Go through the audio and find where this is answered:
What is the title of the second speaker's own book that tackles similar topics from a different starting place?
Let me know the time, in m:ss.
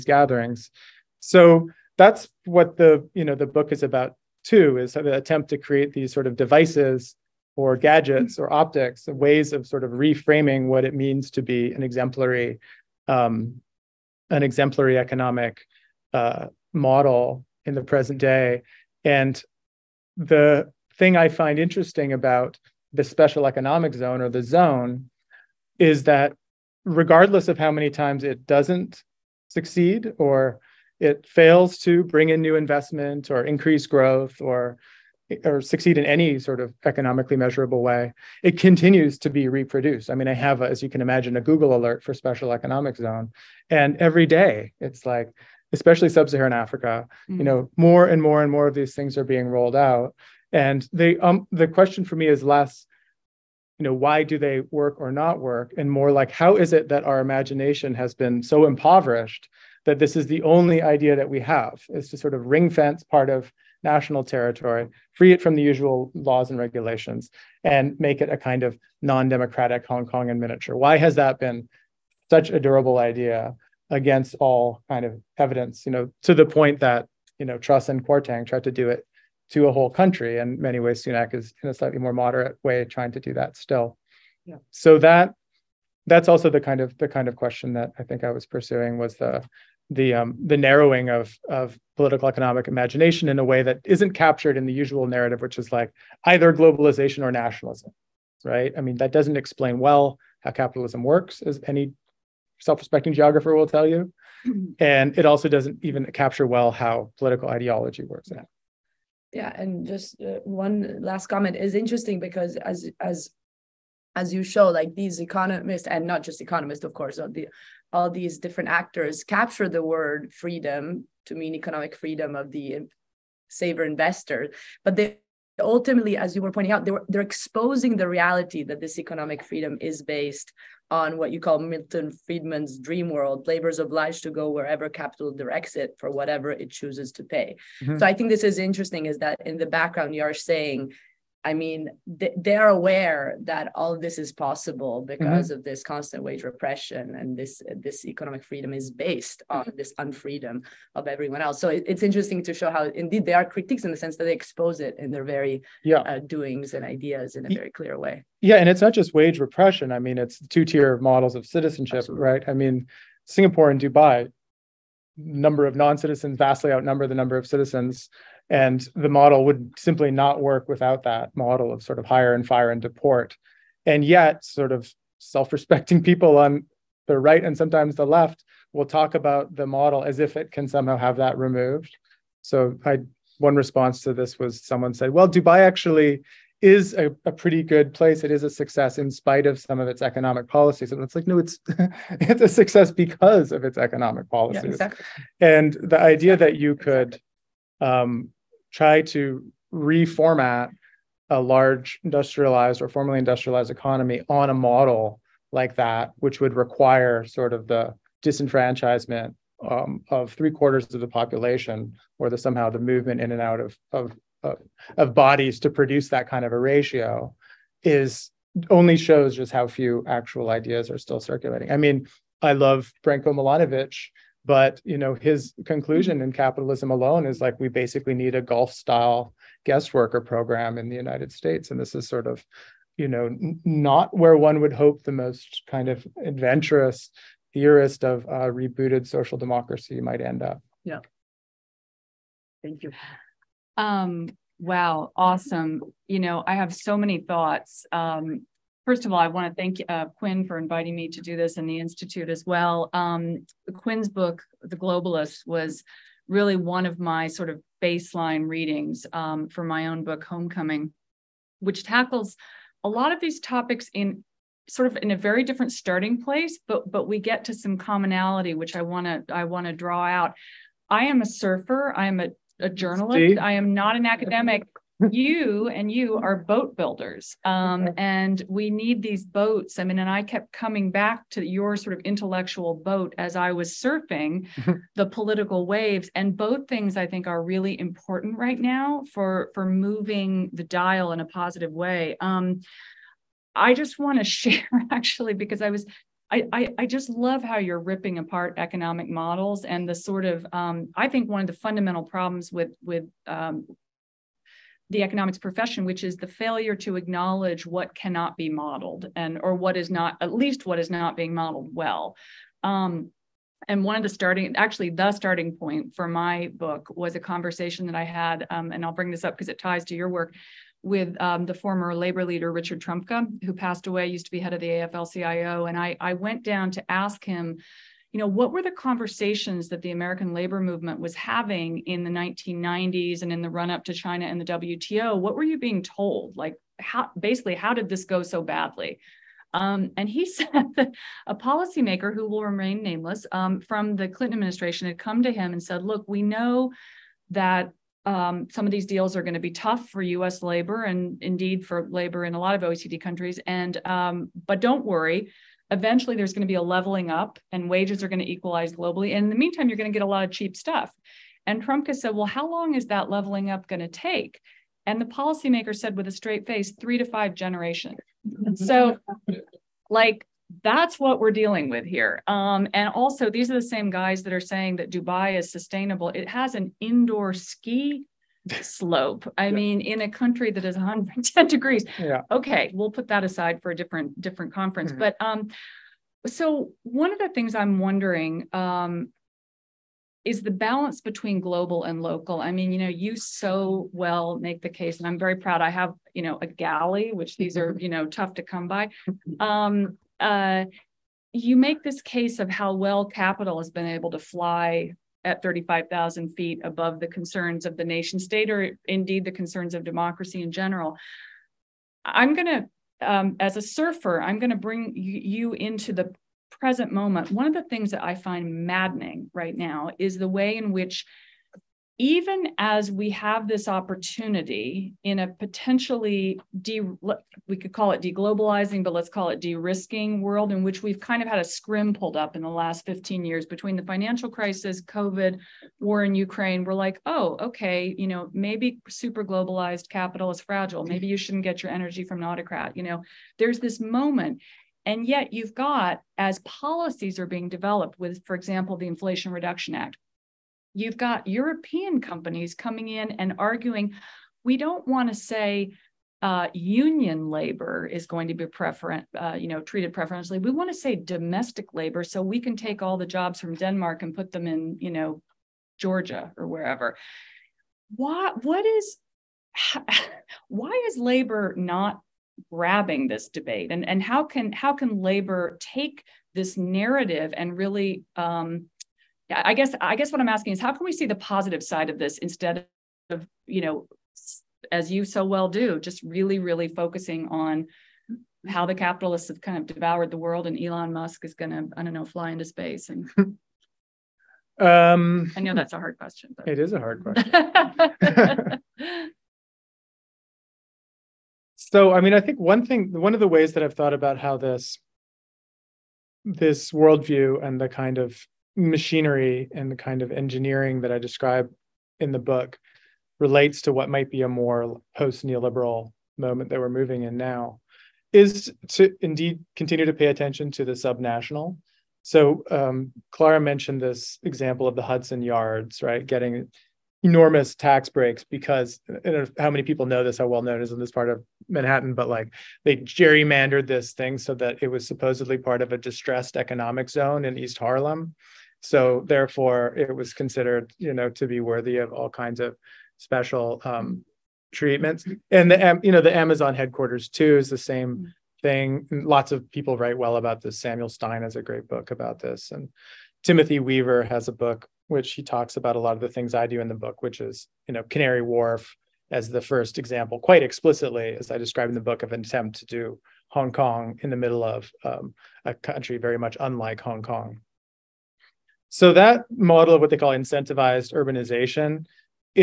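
4:20.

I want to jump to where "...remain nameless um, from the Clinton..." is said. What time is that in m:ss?
5:42.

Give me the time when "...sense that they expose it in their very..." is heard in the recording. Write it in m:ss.
2:33.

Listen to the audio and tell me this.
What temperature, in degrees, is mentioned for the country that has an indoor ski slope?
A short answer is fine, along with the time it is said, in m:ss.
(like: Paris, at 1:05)
110, at 6:20.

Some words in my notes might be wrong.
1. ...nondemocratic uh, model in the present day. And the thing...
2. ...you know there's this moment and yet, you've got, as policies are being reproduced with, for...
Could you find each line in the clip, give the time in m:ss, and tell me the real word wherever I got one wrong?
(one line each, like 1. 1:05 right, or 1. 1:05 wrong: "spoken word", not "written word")
1. 0:14 wrong: "economic", not "nondemocratic"
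2. 7:22 wrong: "developed", not "reproduced".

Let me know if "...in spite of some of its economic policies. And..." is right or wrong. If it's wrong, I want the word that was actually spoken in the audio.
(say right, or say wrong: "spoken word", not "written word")
right.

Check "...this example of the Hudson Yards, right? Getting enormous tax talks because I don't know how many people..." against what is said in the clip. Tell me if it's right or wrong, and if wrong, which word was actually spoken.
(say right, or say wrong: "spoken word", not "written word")
wrong: "breaks", not "talks".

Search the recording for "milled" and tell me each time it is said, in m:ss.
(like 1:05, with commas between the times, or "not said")
not said.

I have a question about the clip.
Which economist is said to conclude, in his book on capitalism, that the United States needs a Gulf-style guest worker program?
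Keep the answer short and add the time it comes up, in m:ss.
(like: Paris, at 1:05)
Branko Milanovic, at 3:43.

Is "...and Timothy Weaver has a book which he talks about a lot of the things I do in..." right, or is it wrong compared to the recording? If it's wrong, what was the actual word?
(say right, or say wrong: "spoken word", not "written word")
right.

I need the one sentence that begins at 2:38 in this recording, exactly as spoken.
Yeah, and it's not just wage repression.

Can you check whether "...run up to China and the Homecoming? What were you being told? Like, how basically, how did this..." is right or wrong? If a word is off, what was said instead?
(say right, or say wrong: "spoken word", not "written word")
wrong: "WTO", not "Homecoming".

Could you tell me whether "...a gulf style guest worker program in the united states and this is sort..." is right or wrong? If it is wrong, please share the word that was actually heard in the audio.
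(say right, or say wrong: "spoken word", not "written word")
right.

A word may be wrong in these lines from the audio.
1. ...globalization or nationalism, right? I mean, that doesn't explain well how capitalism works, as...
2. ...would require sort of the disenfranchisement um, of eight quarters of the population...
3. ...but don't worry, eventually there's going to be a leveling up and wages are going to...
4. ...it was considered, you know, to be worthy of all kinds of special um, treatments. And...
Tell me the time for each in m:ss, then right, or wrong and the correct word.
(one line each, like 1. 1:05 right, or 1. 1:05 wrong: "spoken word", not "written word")
1. 1:36 right
2. 3:26 wrong: "three", not "eight"
3. 5:54 right
4. 8:59 right.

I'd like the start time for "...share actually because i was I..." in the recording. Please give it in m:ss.
4:54.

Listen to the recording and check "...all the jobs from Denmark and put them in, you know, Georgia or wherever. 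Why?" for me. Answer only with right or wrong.
right.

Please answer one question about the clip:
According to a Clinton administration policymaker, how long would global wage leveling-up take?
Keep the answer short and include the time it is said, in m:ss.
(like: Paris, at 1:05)
3 to 5 generations, at 6:06.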